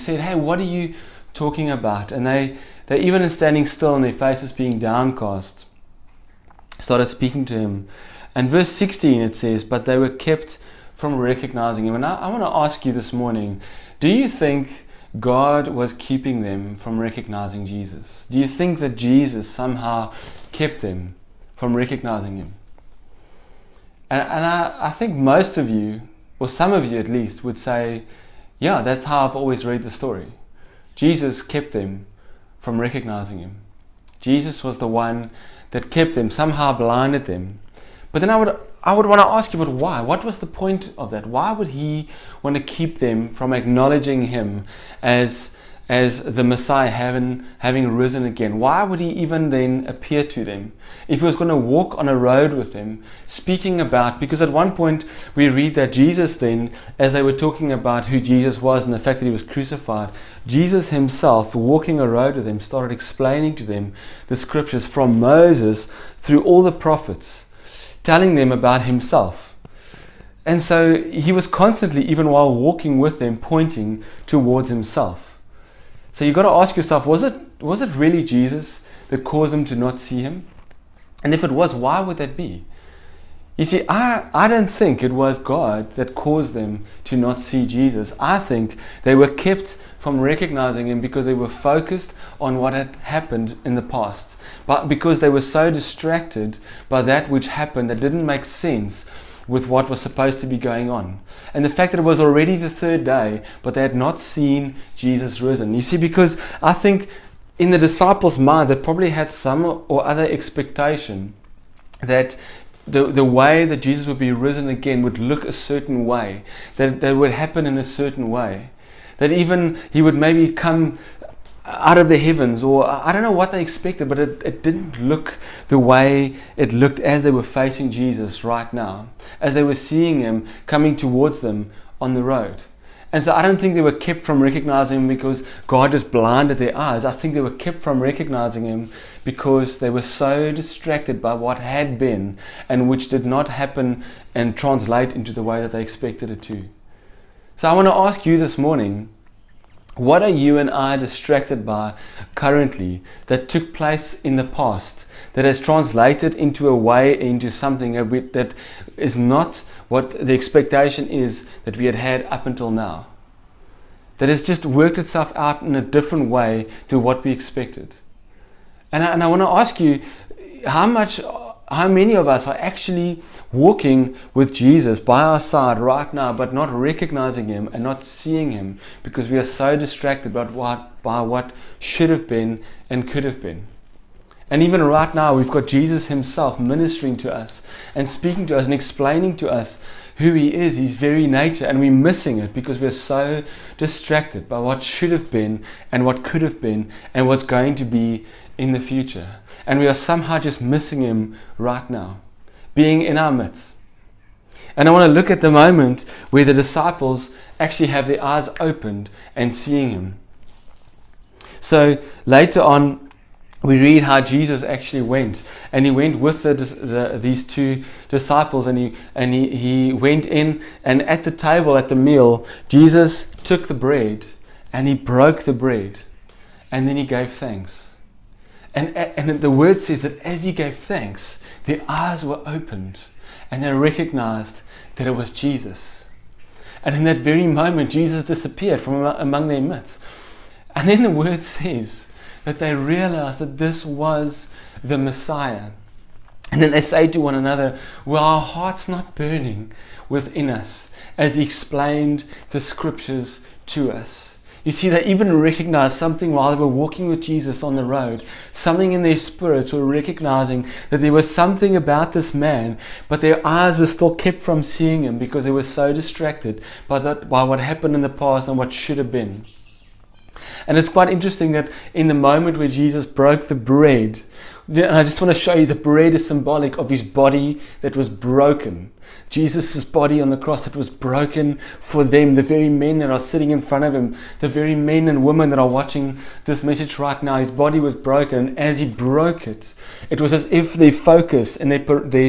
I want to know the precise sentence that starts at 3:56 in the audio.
And in that very moment, Jesus disappeared from among their midst.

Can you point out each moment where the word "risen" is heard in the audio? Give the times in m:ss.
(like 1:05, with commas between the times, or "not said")
0:47, 1:45, 1:54.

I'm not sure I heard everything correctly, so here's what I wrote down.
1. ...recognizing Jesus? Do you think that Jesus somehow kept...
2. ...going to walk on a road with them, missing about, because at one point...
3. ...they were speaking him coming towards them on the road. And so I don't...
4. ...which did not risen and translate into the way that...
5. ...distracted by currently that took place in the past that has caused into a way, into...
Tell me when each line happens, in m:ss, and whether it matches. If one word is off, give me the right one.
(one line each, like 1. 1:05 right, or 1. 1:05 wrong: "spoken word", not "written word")
1. 0:16 right
2. 0:51 wrong: "speaking", not "missing"
3. 2:09 wrong: "seeing", not "speaking"
4. 2:22 wrong: "happen", not "risen"
5. 2:30 wrong: "translated", not "caused".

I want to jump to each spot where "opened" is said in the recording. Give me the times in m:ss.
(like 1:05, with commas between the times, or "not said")
3:28, 3:52.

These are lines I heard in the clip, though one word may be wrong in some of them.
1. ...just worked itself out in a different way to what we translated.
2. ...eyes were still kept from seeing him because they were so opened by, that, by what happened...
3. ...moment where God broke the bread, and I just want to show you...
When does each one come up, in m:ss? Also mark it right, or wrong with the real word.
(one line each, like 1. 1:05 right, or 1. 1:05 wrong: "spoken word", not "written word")
1. 2:44 wrong: "expected", not "translated"
2. 4:23 wrong: "distracted", not "opened"
3. 4:32 wrong: "Jesus", not "God".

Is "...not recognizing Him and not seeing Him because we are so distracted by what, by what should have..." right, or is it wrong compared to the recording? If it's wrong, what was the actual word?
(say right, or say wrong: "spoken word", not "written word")
right.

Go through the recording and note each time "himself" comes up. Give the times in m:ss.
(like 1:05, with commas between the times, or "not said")
1:00, 1:08, 1:14, 3:06.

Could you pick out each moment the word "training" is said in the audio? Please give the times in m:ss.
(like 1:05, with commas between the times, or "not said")
not said.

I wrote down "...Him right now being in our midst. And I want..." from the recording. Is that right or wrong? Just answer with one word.
right.